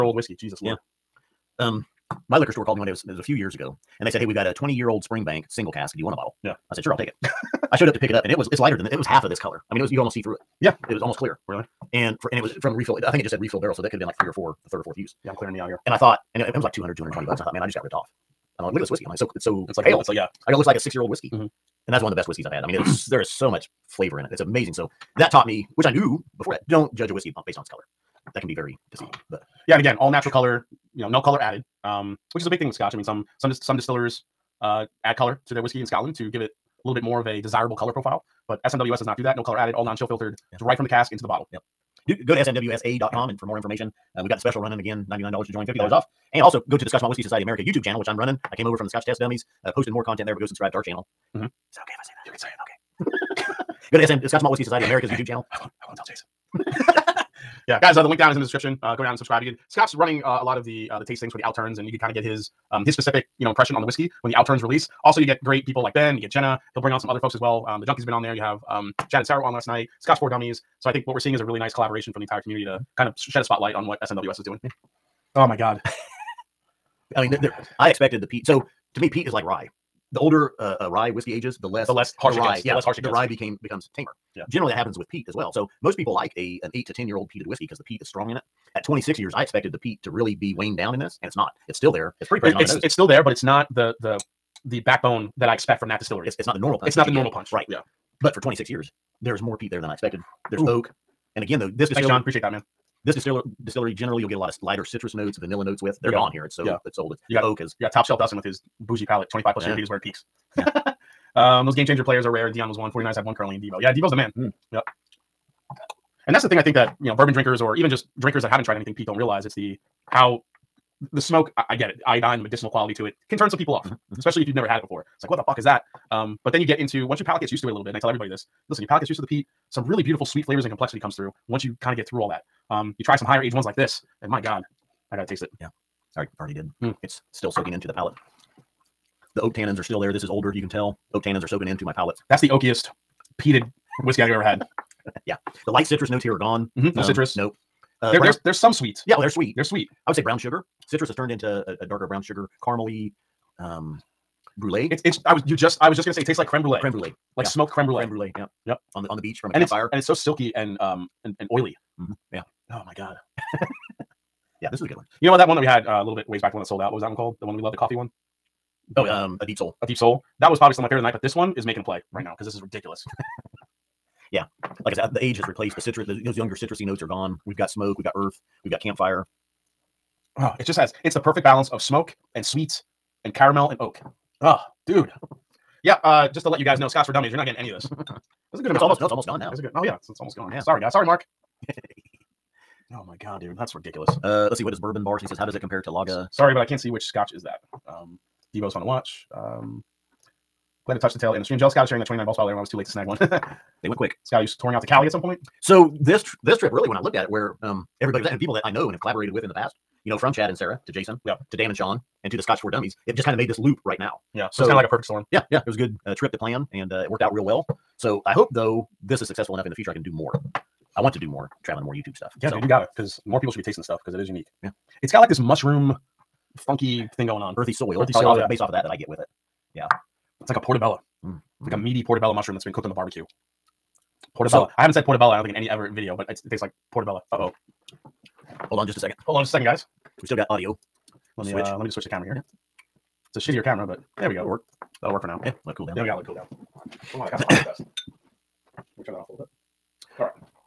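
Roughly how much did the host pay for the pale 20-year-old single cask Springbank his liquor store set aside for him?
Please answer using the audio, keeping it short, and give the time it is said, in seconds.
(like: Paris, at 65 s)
$220, at 16 s.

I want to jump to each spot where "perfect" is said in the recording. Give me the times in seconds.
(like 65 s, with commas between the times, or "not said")
181 s, 214 s.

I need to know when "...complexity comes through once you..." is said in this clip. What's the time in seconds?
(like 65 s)
130 s.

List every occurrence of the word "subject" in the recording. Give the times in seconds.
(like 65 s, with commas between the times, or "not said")
not said.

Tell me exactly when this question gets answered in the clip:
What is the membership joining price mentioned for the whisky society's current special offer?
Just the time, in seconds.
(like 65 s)
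45 s.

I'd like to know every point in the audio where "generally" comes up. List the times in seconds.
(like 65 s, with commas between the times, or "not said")
84 s, 103 s.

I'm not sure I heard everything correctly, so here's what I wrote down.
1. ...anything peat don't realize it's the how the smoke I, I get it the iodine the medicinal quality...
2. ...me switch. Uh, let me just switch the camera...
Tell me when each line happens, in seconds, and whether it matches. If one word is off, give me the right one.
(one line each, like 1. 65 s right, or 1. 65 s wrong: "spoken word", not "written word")
1. 118 s right
2. 241 s right.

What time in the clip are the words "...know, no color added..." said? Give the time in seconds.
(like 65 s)
31 s.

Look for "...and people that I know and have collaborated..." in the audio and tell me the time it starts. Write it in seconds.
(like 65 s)
208 s.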